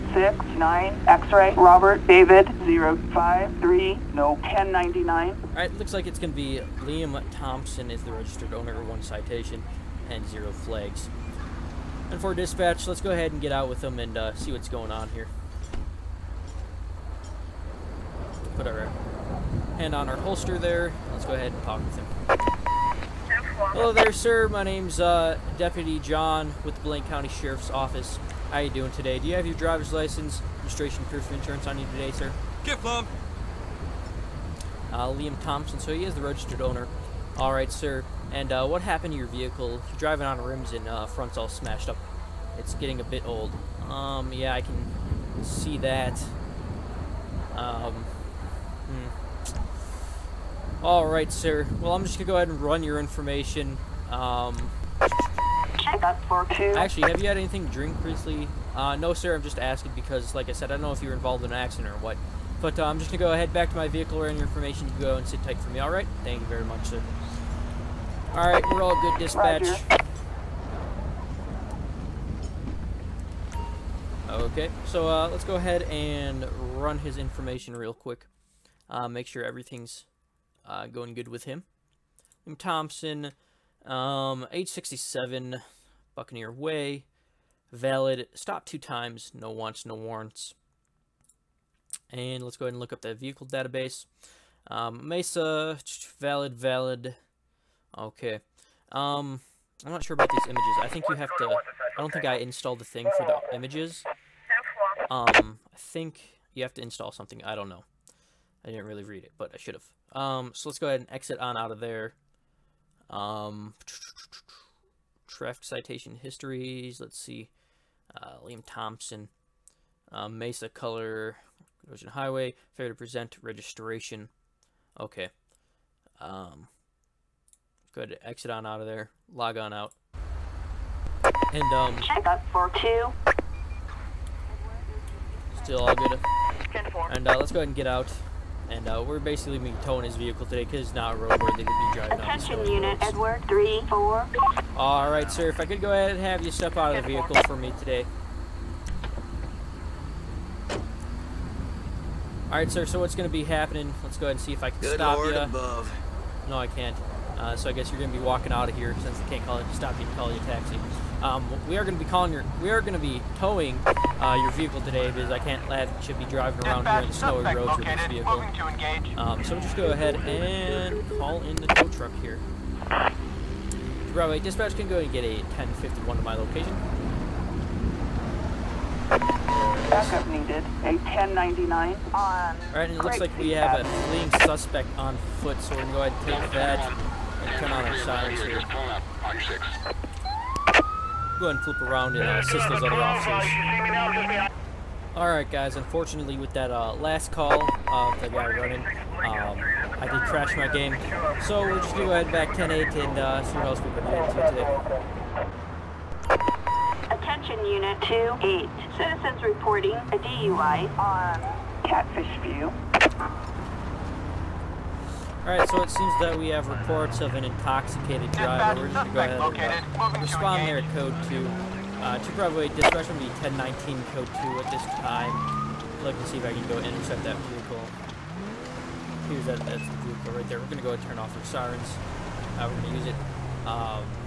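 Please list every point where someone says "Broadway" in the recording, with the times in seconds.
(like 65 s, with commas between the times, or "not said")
174 s, 222 s.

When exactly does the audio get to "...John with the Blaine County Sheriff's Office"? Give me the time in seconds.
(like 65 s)
25 s.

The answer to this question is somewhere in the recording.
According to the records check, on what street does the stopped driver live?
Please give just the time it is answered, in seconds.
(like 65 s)
86 s.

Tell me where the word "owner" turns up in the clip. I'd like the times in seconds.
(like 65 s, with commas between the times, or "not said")
8 s, 36 s.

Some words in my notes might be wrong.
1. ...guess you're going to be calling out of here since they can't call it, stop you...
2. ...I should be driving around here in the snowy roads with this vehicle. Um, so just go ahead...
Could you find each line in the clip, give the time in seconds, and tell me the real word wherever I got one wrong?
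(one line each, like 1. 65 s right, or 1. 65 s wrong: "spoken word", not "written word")
1. 157 s wrong: "walking", not "calling"
2. 165 s right.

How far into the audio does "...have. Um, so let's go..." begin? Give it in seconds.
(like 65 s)
109 s.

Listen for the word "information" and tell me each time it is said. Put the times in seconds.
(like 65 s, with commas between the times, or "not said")
52 s, 64 s, 77 s.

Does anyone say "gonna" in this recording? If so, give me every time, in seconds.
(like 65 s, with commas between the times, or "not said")
52 s, 63 s, 185 s.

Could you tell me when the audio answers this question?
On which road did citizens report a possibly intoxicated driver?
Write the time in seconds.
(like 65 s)
211 s.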